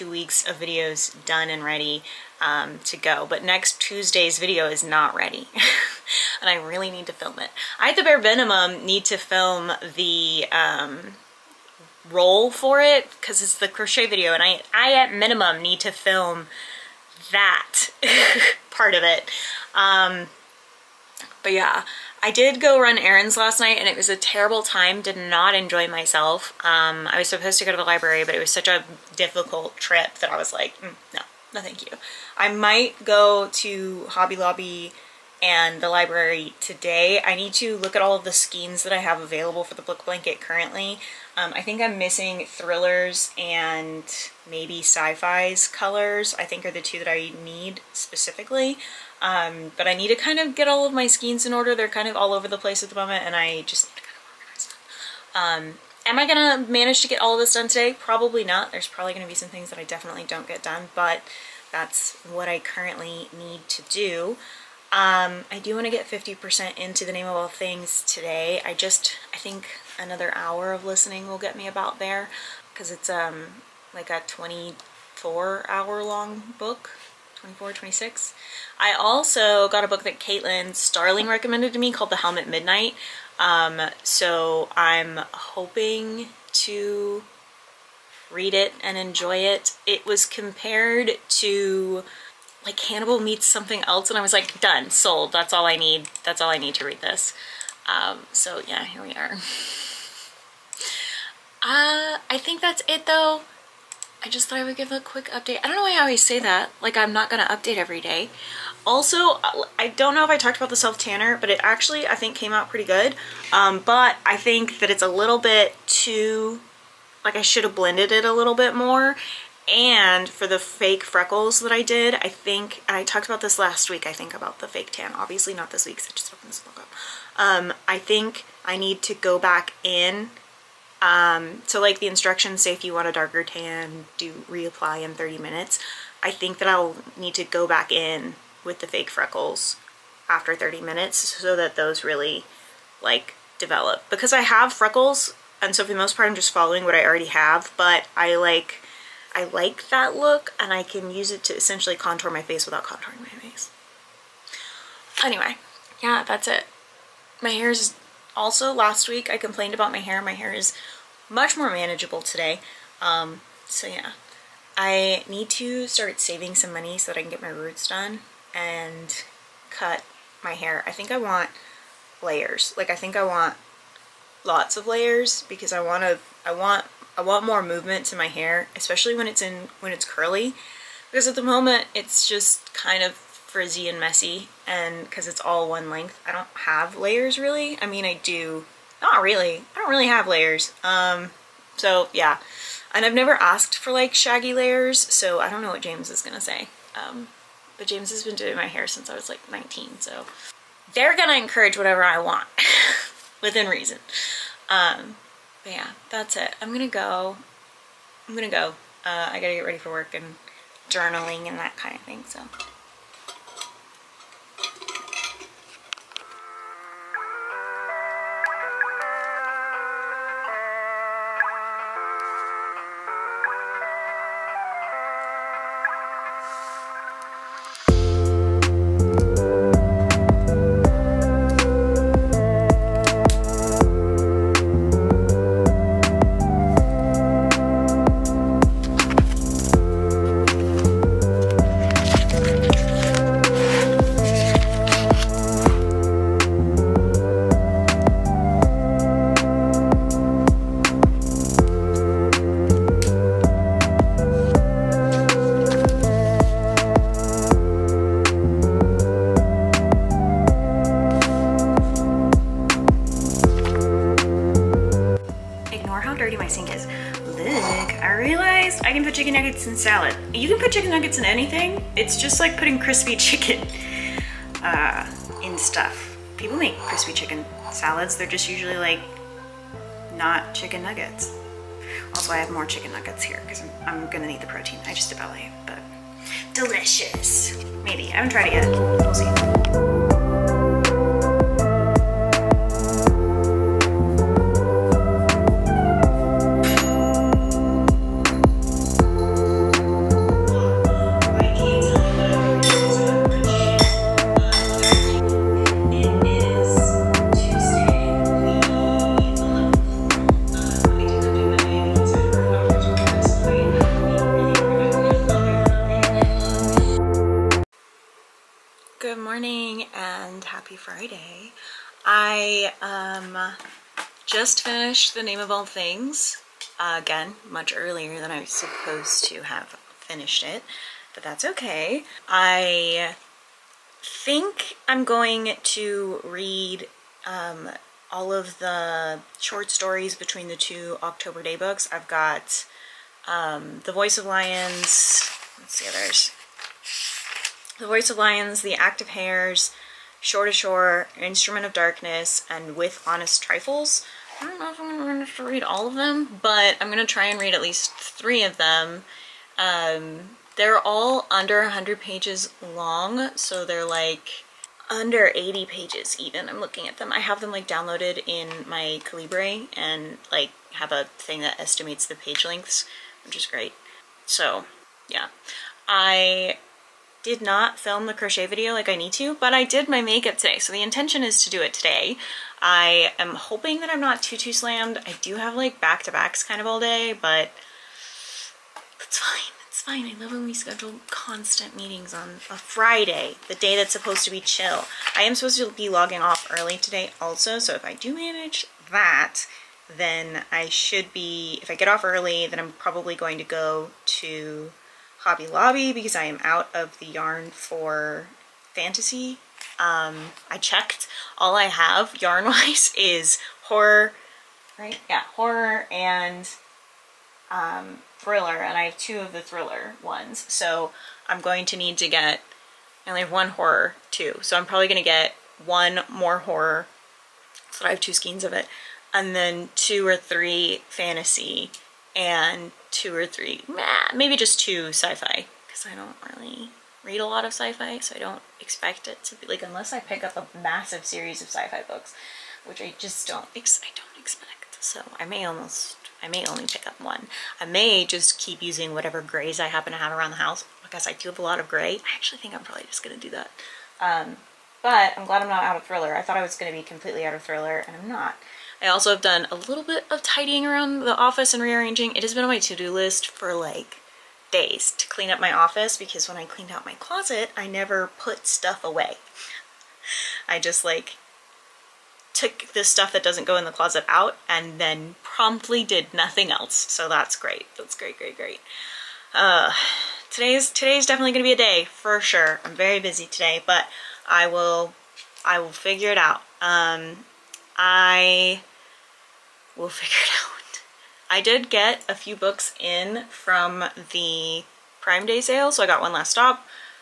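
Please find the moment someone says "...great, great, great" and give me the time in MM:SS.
07:57.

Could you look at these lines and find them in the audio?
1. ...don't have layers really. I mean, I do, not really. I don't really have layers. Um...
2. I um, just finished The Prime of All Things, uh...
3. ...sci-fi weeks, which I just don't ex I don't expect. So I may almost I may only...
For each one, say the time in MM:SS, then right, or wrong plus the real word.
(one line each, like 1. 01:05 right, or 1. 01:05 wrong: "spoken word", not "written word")
1. 03:06 right
2. 05:22 wrong: "Name", not "Prime"
3. 07:21 wrong: "books", not "weeks".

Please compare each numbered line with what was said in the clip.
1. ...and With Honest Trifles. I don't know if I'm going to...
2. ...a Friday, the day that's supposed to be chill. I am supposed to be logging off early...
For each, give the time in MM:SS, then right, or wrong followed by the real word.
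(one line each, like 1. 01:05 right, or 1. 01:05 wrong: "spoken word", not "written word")
1. 05:52 right
2. 06:32 right.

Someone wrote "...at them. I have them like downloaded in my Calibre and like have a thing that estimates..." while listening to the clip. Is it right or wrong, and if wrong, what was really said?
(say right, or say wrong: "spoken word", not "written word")
right.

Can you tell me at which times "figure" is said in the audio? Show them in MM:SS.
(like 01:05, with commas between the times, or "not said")
08:05, 08:09.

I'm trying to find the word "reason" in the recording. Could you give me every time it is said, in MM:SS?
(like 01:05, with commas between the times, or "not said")
03:23.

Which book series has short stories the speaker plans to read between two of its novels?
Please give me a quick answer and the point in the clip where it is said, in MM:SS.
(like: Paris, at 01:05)
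October Daye, at 05:41.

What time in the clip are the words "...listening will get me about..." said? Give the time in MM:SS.
01:10.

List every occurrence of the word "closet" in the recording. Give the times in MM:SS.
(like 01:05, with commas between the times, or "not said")
07:46, 07:53.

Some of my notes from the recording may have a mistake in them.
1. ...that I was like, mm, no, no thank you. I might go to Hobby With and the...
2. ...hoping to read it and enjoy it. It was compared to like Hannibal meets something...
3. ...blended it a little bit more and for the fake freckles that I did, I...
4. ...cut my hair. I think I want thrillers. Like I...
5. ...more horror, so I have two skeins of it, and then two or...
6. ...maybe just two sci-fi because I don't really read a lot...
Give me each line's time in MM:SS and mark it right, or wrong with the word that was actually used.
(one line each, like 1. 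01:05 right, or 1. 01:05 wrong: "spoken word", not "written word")
1. 00:30 wrong: "Lobby", not "With"
2. 01:25 right
3. 01:57 right
4. 02:49 wrong: "layers", not "thrillers"
5. 07:06 right
6. 07:14 right.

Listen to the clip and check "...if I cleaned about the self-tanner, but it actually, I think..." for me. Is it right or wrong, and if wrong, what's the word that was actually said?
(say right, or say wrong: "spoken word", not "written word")
wrong: "talked", not "cleaned".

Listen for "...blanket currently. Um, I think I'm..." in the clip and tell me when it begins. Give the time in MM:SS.
00:40.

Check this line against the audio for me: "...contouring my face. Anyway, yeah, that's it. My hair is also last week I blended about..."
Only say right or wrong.
wrong.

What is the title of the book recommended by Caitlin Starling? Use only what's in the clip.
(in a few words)
The Helm of Midnight.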